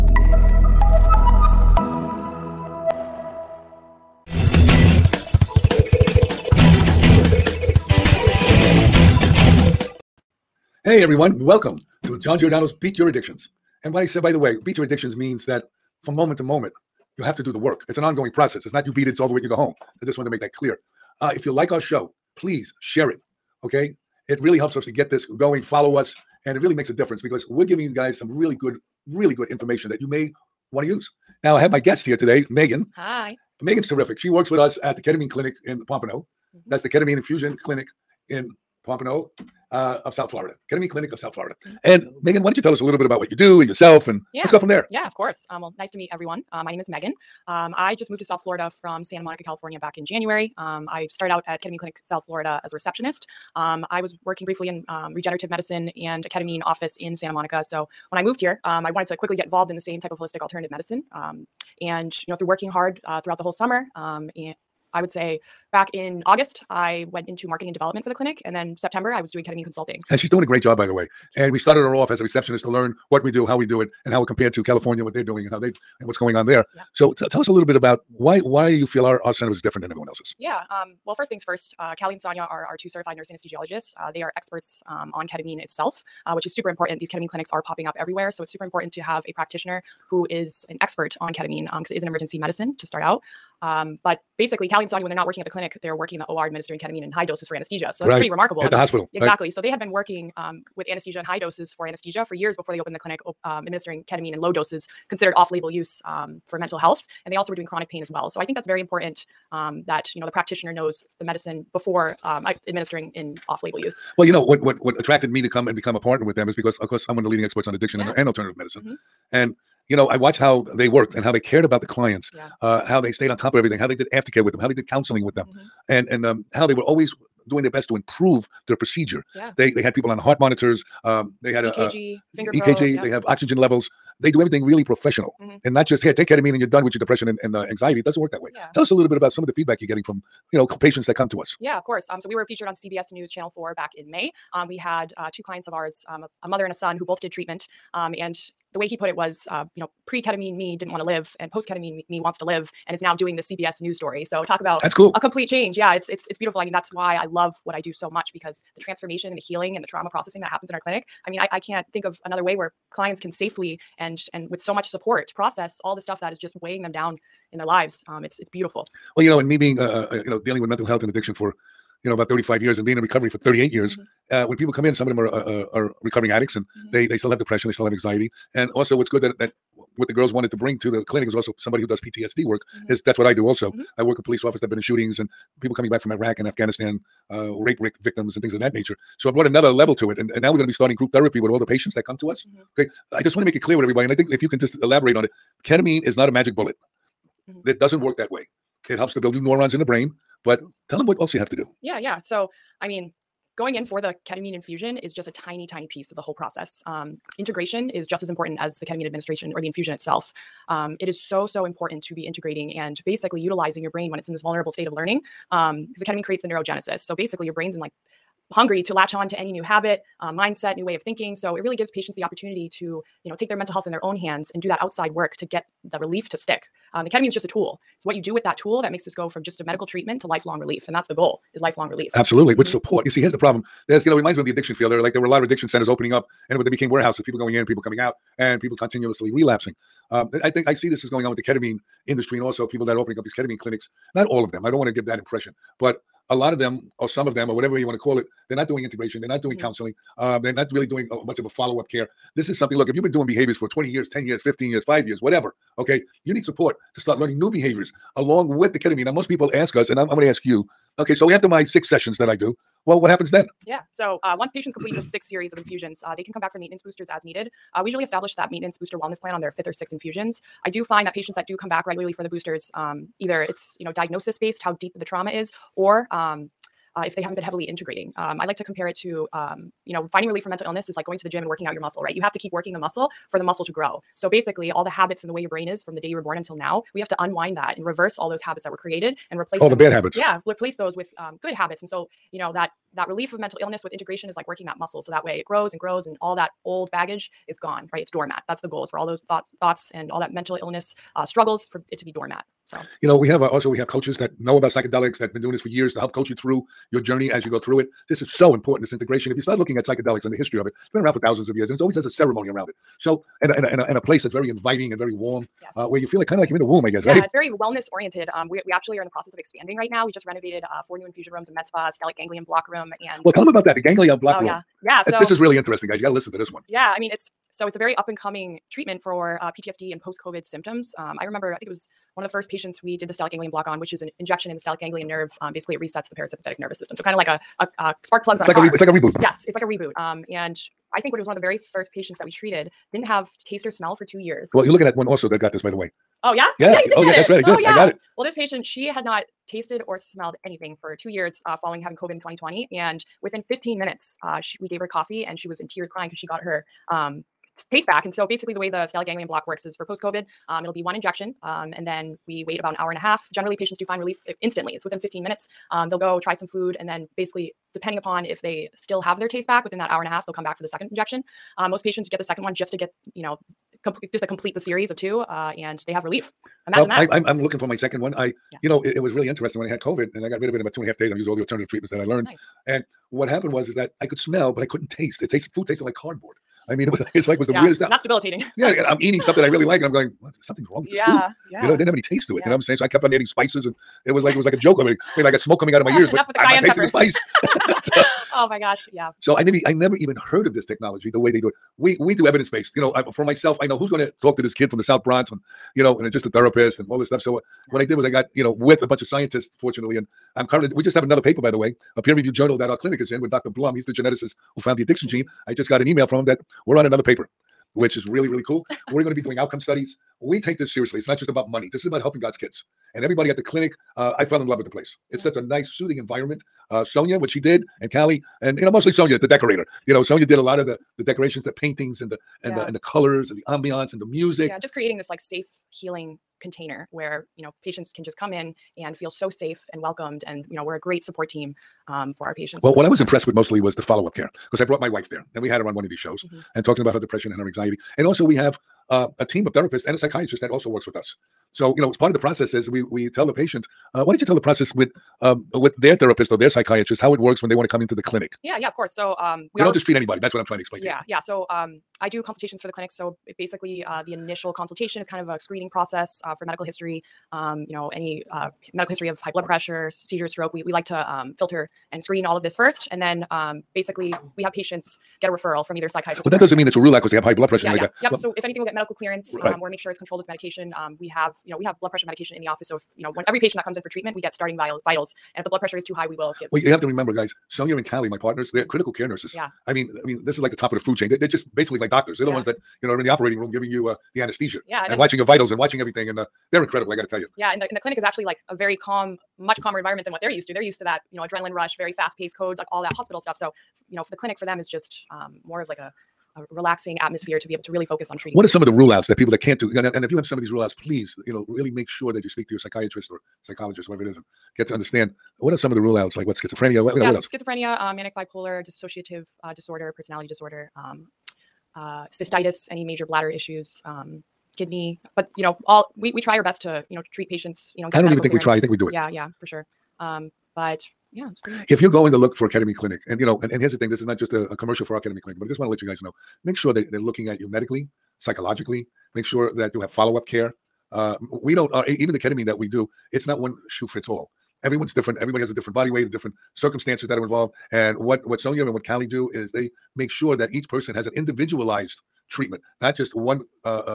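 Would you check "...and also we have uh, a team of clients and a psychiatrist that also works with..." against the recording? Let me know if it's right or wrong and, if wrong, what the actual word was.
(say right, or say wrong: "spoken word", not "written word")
wrong: "therapists", not "clients".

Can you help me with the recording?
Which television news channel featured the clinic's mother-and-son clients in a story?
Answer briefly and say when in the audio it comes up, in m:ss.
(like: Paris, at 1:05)
CBS News Channel 4, at 2:22.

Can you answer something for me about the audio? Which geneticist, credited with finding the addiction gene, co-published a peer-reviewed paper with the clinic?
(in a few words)
Dr. Blum.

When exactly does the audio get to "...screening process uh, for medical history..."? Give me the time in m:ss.
7:45.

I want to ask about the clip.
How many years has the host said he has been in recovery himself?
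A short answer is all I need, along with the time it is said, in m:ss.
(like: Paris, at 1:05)
38, at 2:53.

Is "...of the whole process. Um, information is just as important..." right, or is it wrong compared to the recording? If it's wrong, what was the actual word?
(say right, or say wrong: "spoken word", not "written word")
wrong: "integration", not "information".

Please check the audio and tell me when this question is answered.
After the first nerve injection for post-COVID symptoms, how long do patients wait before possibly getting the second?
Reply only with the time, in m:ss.
6:02.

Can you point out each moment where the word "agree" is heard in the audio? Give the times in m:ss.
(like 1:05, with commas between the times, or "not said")
not said.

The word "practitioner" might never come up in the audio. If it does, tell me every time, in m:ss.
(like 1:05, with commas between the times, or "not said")
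1:29, 1:50.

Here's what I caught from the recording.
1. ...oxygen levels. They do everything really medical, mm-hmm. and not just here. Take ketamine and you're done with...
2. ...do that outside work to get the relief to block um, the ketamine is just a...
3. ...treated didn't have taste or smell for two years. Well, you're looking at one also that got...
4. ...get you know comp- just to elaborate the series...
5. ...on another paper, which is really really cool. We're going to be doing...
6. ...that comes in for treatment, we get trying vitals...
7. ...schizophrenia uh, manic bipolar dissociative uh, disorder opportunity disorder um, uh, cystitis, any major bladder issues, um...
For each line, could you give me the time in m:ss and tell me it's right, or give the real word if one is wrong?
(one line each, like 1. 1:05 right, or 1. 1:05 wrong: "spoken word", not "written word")
1. 2:13 wrong: "professional", not "medical"
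2. 3:44 wrong: "stick", not "block"
3. 5:42 right
4. 6:12 wrong: "complete", not "elaborate"
5. 6:56 right
6. 8:03 wrong: "starting", not "trying"
7. 8:37 wrong: "personality", not "opportunity".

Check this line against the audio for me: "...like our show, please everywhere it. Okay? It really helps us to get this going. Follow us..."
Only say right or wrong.
wrong.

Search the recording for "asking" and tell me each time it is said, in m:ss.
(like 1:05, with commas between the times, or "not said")
not said.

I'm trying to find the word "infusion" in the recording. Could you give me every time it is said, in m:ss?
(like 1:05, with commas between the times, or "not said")
0:37, 3:24, 3:29, 4:25, 4:29, 5:21.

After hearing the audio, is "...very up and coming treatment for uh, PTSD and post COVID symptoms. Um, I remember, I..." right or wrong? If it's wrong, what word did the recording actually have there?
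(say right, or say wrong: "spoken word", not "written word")
right.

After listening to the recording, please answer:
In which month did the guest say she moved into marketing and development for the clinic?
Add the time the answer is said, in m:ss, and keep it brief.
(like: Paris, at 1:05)
August, at 1:06.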